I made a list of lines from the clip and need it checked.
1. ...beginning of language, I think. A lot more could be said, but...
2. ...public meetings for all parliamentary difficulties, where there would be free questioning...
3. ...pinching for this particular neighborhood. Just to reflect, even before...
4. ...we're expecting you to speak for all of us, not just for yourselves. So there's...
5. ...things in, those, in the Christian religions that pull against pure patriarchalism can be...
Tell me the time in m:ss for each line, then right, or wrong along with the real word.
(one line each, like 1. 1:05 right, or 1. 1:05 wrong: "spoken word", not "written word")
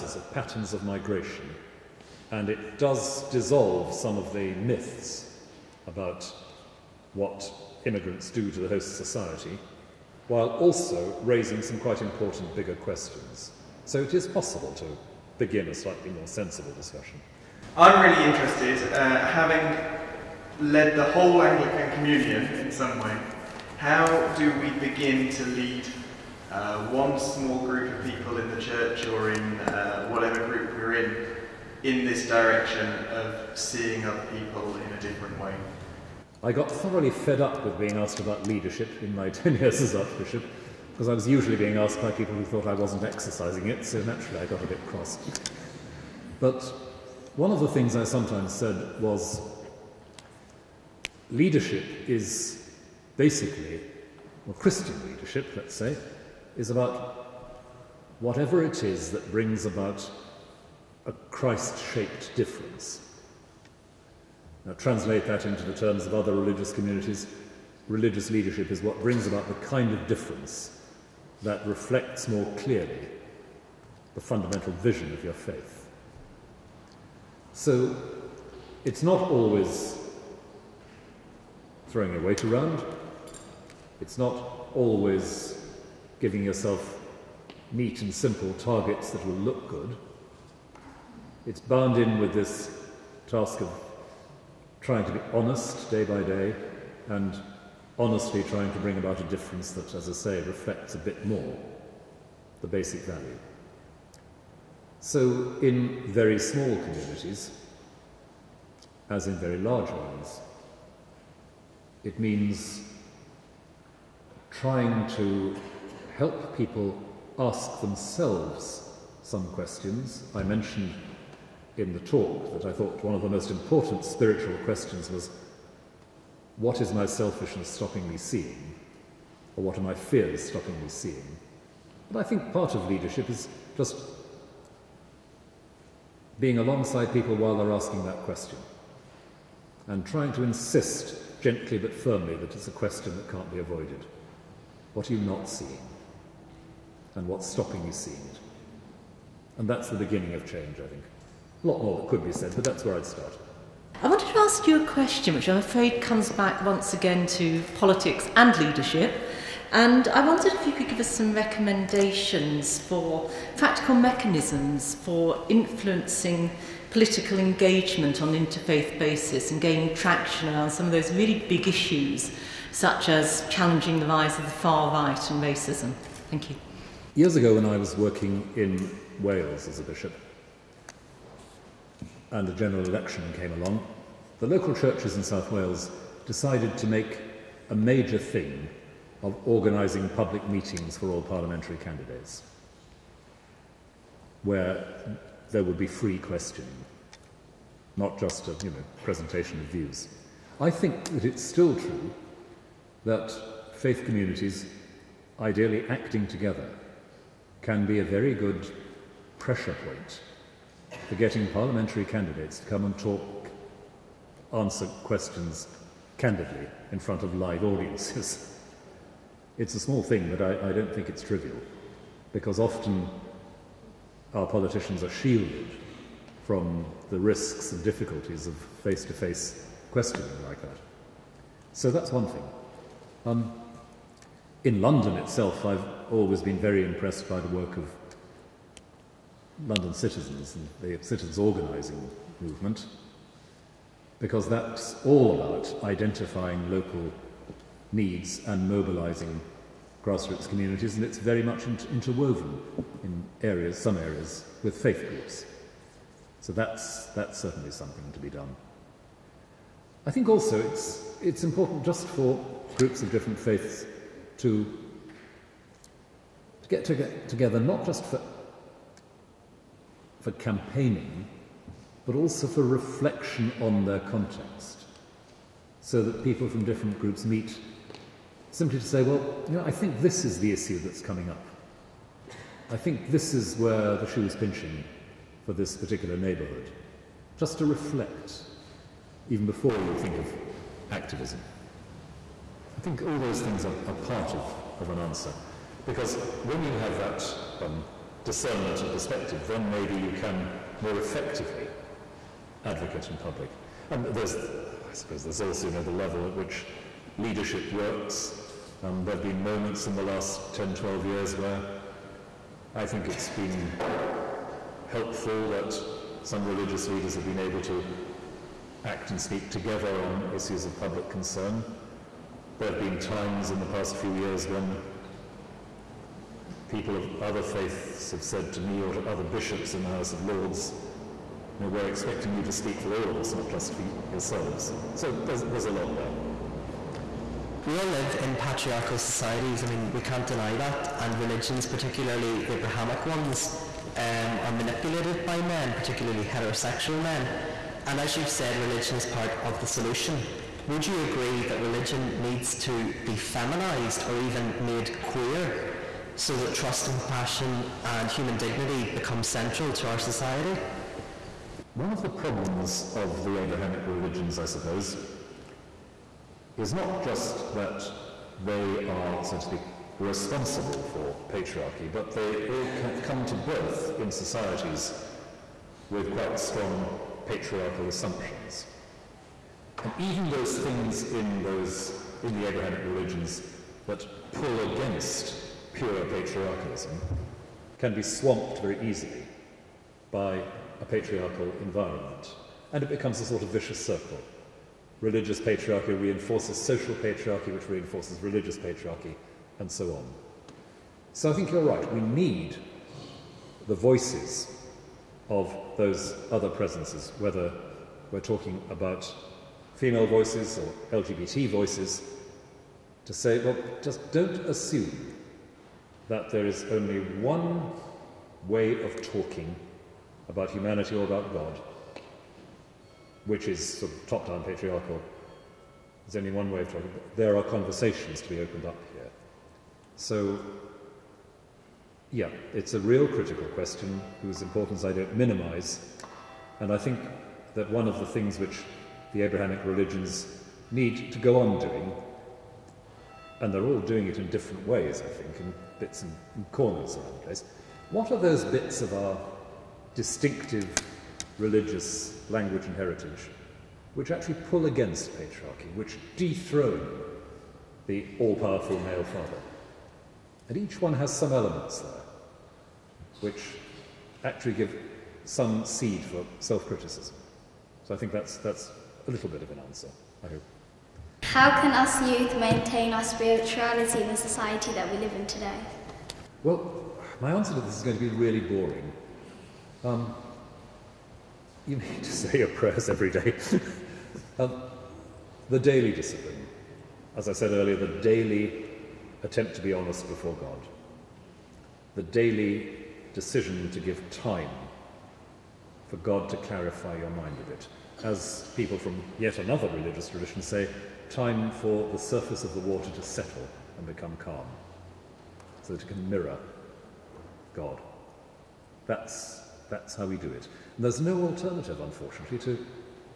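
1. 2:29 wrong: "change", not "language"
2. 3:10 wrong: "candidates", not "difficulties"
3. 4:44 right
4. 5:31 right
5. 6:20 wrong: "Abrahamic", not "Christian".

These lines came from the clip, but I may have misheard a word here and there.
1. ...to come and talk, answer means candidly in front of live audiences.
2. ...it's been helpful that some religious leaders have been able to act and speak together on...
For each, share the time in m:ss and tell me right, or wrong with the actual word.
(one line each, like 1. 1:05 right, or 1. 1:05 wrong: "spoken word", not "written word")
1. 3:32 wrong: "questions", not "means"
2. 5:13 right.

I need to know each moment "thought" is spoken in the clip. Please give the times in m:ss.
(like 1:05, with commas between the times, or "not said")
0:42, 2:02.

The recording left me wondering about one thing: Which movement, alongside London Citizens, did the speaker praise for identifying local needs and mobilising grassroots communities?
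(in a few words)
citizens organising movement.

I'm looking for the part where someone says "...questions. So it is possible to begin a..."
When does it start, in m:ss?
0:12.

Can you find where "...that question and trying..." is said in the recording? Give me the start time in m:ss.
2:18.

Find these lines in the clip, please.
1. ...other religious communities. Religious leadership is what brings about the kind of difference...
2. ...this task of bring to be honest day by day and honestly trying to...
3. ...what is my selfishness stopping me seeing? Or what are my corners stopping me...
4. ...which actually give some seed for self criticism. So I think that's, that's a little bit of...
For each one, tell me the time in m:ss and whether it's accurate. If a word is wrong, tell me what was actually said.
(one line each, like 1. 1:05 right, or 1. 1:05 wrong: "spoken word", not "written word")
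1. 1:06 right
2. 1:32 wrong: "trying", not "bring"
3. 2:06 wrong: "fears", not "corners"
4. 7:43 right.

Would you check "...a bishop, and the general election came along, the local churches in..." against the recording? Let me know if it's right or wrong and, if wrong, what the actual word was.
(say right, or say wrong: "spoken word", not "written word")
right.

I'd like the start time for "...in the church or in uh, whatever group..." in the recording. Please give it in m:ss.
0:28.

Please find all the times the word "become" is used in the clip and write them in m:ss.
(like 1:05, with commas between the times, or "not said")
5:58, 6:32, 8:23.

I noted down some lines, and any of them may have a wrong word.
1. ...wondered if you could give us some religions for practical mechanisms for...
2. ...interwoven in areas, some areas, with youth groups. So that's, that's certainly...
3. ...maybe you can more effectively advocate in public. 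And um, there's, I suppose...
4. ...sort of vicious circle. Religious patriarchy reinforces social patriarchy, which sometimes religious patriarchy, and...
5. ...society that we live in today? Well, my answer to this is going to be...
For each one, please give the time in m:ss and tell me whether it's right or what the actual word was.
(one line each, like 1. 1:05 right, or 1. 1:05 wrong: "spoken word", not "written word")
1. 2:40 wrong: "recommendations", not "religions"
2. 4:11 wrong: "faith", not "youth"
3. 4:59 right
4. 6:33 wrong: "reinforces", not "sometimes"
5. 7:54 right.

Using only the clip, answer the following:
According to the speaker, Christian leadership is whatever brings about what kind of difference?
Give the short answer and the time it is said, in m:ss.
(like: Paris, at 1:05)
Christ shaped difference, at 1:01.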